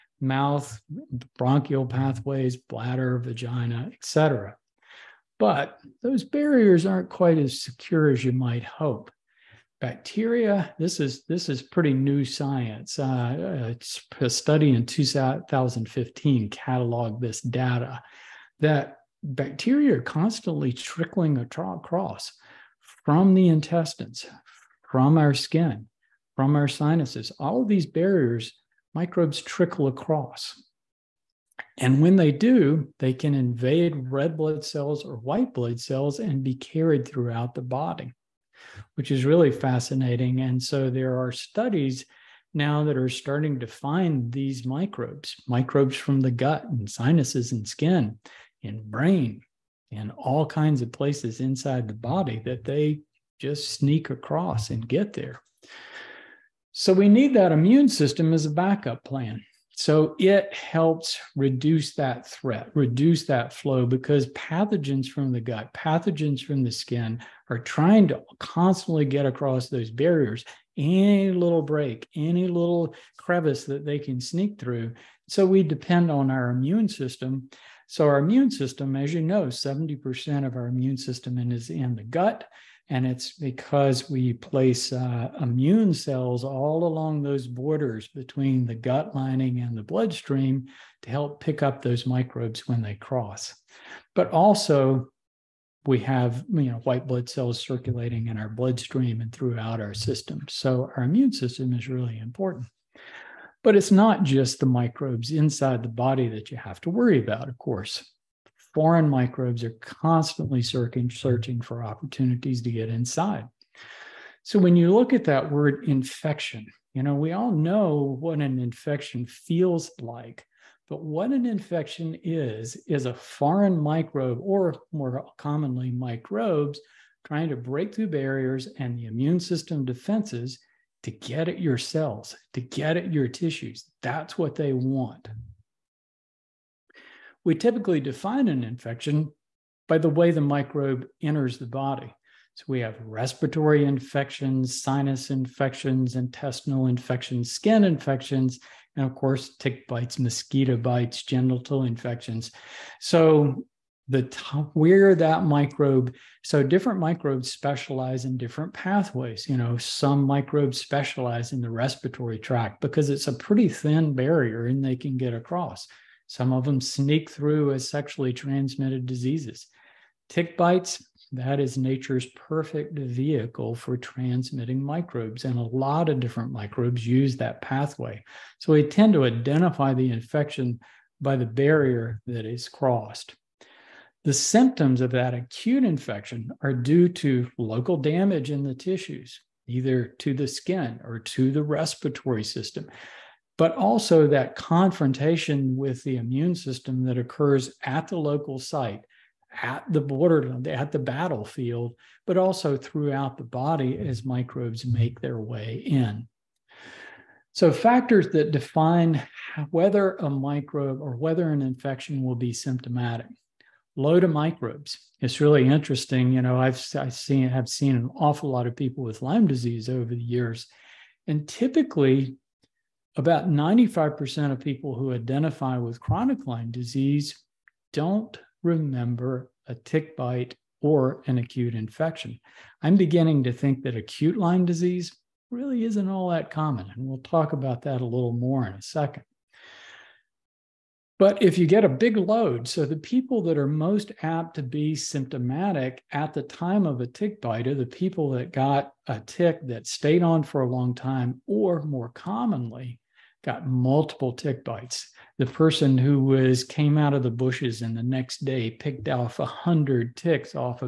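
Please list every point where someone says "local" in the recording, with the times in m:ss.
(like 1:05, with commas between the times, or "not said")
3:07, 3:18.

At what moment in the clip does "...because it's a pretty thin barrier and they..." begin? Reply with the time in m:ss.
2:42.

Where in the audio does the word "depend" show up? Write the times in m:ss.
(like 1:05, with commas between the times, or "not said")
1:15.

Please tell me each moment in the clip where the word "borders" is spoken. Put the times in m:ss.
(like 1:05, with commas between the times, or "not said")
1:27, 3:19.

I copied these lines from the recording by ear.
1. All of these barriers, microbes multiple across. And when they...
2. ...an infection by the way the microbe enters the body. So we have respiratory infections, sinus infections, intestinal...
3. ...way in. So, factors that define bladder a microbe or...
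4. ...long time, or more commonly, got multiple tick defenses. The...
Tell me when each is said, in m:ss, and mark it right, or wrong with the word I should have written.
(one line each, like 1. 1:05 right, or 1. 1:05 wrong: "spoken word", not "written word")
1. 0:27 wrong: "trickle", not "multiple"
2. 2:18 right
3. 3:25 wrong: "whether", not "bladder"
4. 4:10 wrong: "bites", not "defenses".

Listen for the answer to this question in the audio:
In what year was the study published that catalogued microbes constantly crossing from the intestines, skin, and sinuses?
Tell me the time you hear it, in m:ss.
0:14.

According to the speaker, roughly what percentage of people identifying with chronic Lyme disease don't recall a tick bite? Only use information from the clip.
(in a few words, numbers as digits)
95%.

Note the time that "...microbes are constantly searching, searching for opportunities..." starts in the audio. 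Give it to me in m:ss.
1:49.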